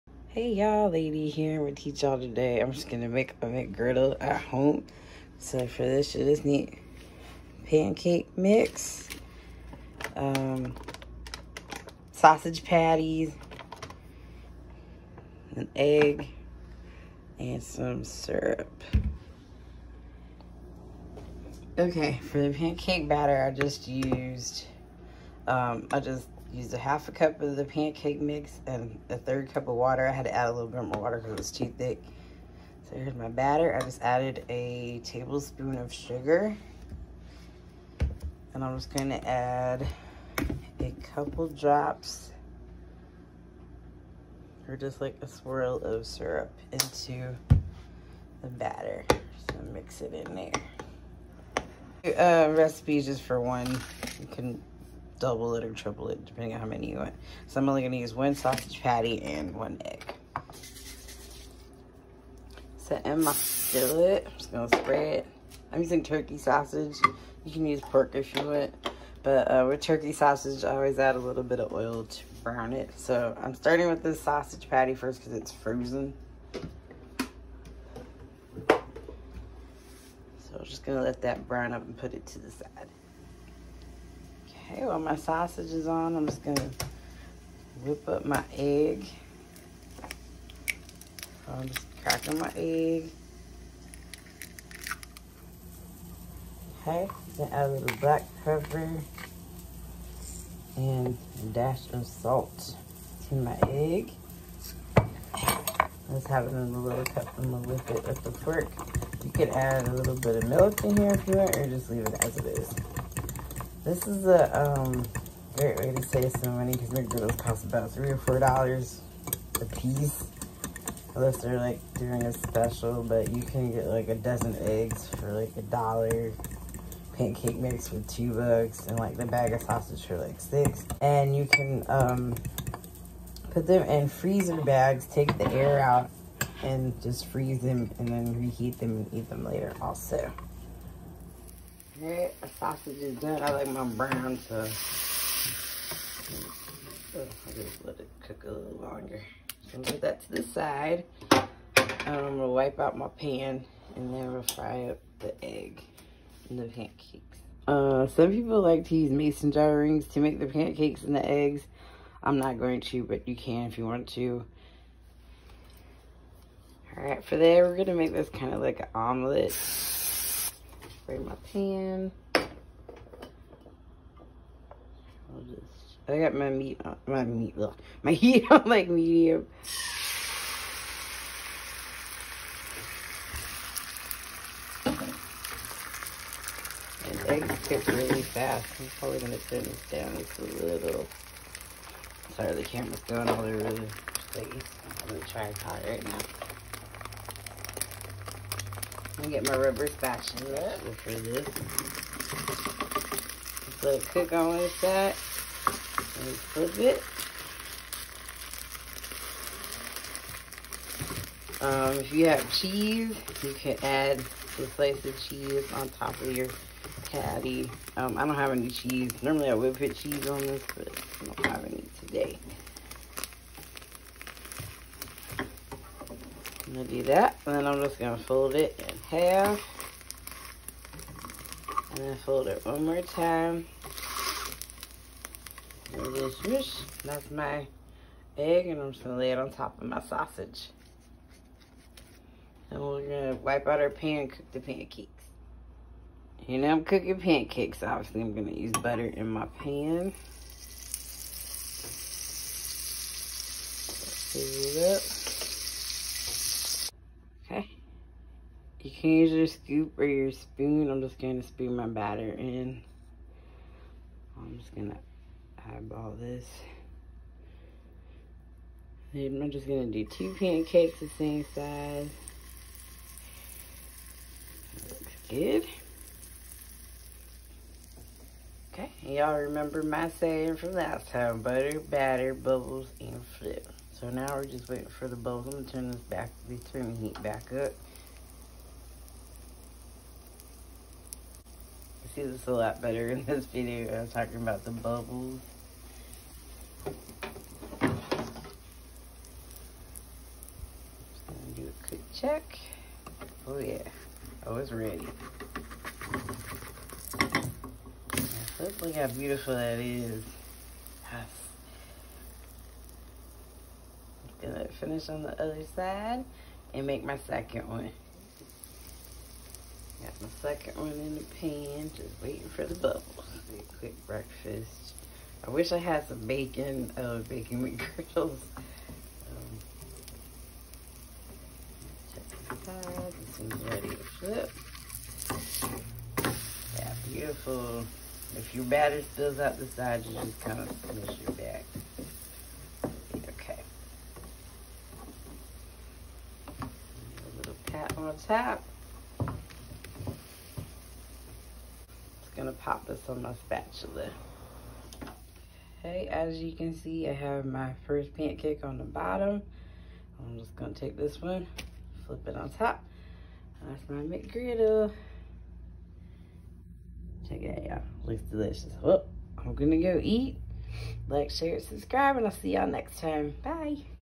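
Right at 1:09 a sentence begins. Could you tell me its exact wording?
But uh, with turkey sausage, I always add a little bit of oil to brown it.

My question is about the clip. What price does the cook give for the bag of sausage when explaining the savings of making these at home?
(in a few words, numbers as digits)
$6.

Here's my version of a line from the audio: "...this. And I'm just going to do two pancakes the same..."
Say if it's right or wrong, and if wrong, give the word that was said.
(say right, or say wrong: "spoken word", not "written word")
right.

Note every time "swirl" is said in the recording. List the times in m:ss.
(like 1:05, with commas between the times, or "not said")
0:45.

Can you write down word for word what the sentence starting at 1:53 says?
This is a um, great way to save some money because McDonald's cost about three or four dollars a piece.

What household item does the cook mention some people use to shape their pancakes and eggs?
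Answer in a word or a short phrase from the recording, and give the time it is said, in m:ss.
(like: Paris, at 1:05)
Mason jar rings, at 2:39.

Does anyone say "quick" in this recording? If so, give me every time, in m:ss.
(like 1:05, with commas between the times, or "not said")
5:01, 5:23.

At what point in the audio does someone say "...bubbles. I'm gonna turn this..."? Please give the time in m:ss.
4:45.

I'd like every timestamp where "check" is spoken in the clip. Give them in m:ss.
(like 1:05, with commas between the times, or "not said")
5:02, 5:32, 6:07.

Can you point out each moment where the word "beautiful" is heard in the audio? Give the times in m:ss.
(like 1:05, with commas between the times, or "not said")
5:09, 5:37.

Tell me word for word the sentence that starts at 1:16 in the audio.
So I'm just going to let that brown up and put it to the side.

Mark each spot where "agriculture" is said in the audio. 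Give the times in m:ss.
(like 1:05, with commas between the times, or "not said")
not said.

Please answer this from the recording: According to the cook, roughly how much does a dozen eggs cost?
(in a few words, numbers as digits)
$1.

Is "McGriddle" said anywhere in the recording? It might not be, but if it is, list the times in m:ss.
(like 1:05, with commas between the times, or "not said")
0:03, 5:27, 6:04.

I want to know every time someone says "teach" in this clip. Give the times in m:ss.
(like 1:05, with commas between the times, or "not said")
0:01.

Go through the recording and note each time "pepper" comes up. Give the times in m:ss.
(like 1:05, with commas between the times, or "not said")
1:38.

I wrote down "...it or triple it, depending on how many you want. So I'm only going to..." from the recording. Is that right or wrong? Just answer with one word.
right.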